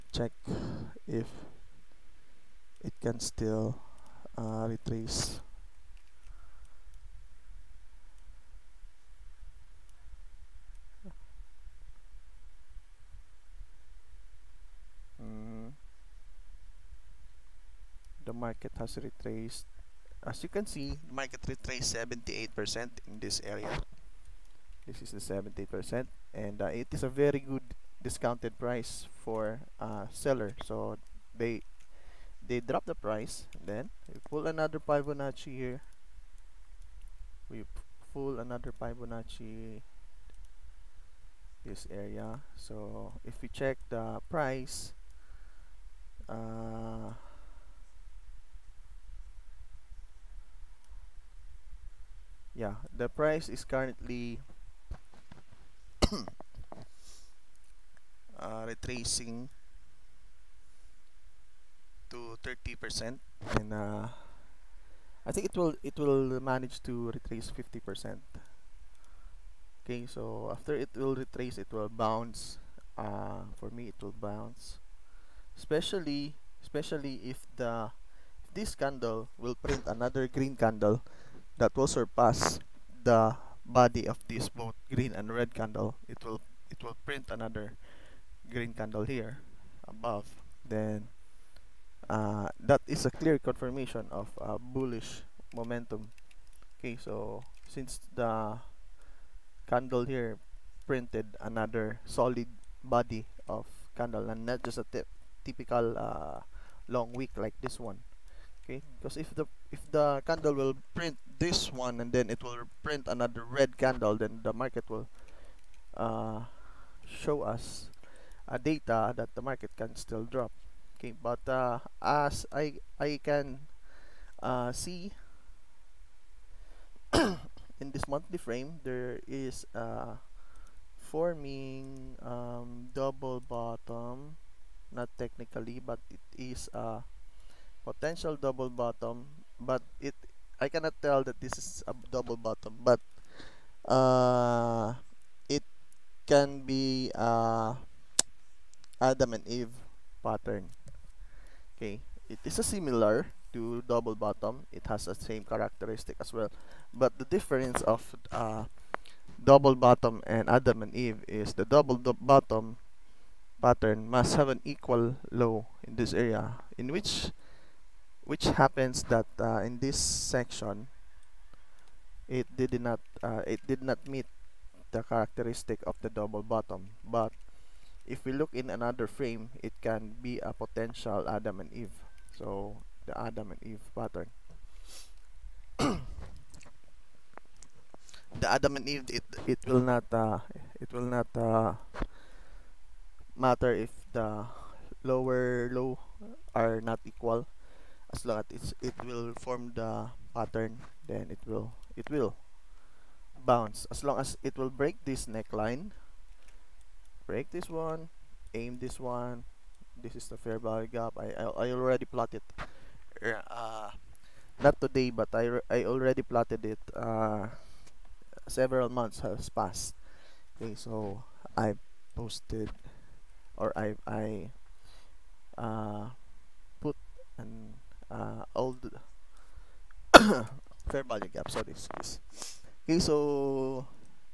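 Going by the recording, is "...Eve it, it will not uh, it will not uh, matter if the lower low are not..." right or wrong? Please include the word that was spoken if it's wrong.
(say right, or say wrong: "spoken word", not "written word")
right.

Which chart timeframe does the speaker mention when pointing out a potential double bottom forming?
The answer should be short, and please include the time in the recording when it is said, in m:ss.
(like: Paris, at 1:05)
monthly, at 2:08.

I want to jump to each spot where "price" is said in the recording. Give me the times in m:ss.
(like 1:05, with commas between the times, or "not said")
0:28, 0:32, 0:44, 0:53.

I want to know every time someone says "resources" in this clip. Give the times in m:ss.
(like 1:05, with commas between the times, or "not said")
not said.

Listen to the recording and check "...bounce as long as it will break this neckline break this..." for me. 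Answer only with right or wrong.
right.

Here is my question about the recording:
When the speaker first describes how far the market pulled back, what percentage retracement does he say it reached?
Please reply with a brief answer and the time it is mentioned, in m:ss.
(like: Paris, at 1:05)
78%, at 0:21.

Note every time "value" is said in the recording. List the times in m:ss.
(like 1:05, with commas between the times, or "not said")
3:30, 3:51.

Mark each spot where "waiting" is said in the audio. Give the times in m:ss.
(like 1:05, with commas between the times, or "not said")
not said.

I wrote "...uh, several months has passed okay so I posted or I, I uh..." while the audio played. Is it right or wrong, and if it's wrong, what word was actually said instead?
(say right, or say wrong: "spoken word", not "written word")
right.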